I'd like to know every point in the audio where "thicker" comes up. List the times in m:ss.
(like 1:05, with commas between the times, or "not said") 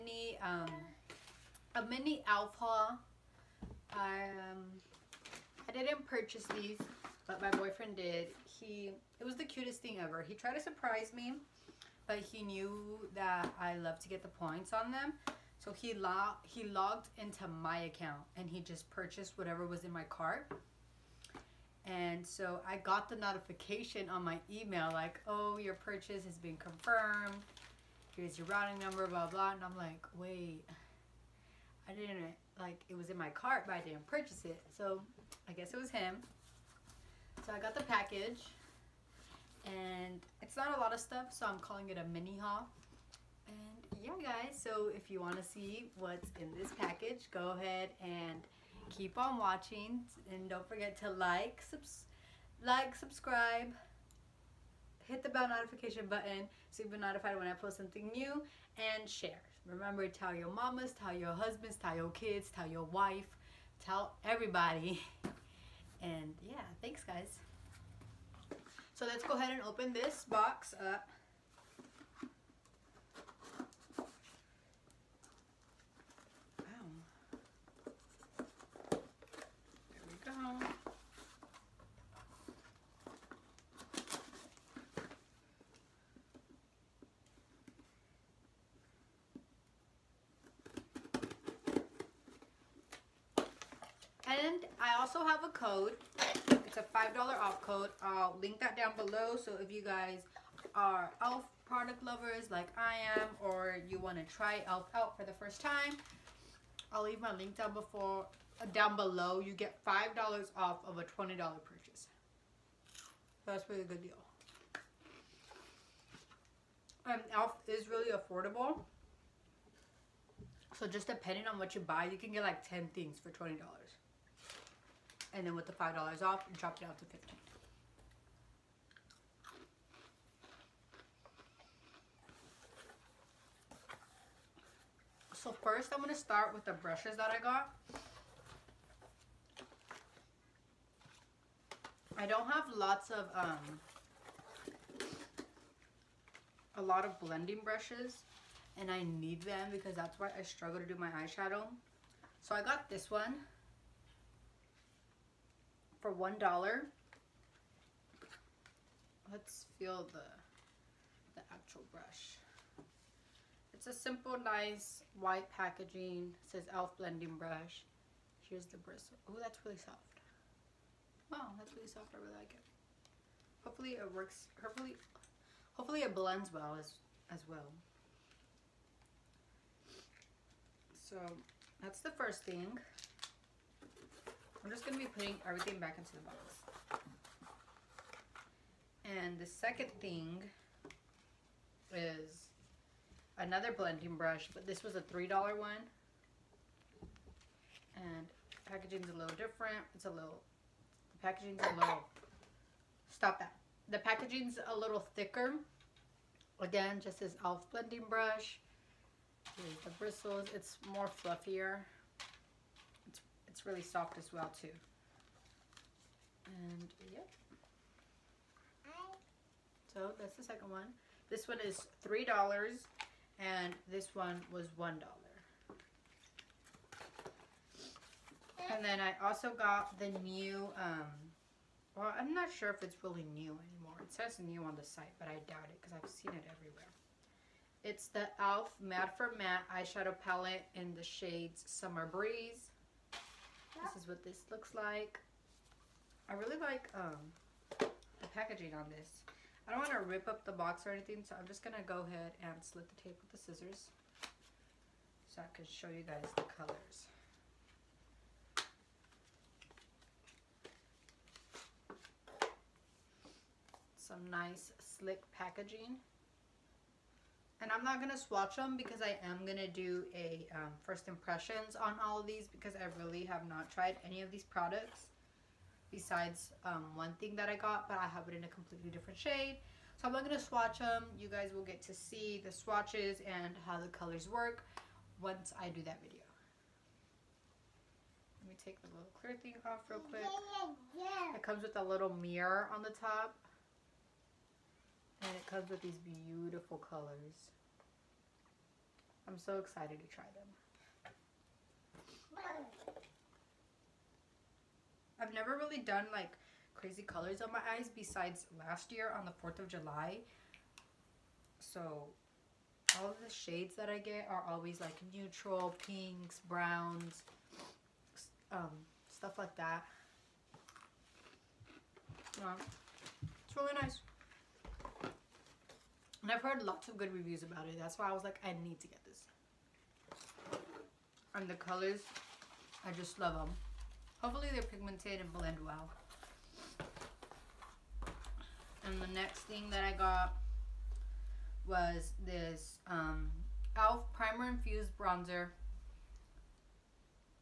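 3:25.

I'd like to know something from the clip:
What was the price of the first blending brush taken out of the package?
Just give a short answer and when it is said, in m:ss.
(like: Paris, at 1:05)
$1, at 2:36.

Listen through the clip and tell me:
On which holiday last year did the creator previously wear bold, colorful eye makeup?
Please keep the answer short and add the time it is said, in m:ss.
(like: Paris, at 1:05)
4th of July, at 5:09.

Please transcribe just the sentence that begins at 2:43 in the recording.
It's a simple, nice white packaging.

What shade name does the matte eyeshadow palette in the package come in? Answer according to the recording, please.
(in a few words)
Summer Breeze.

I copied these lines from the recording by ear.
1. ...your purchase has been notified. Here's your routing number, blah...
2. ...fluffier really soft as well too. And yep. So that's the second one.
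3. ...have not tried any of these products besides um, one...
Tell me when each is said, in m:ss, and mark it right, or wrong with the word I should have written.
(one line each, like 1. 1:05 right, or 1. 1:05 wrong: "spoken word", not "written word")
1. 0:25 wrong: "confirmed", not "notified"
2. 3:31 right
3. 4:33 right.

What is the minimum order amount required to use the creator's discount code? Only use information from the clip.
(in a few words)
$20.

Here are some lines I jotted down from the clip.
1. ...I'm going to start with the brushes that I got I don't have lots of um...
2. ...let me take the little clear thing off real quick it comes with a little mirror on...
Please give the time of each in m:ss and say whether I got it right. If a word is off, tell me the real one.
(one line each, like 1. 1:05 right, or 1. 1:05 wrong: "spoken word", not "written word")
1. 2:15 right
2. 4:48 right.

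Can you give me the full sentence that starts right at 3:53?
It says new on the site, but I doubt it because I've seen it everywhere.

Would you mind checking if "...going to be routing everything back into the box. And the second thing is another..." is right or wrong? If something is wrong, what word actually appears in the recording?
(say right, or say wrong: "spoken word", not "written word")
wrong: "putting", not "routing".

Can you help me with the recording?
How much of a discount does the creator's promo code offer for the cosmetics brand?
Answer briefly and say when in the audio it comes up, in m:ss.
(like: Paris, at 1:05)
$5, at 1:36.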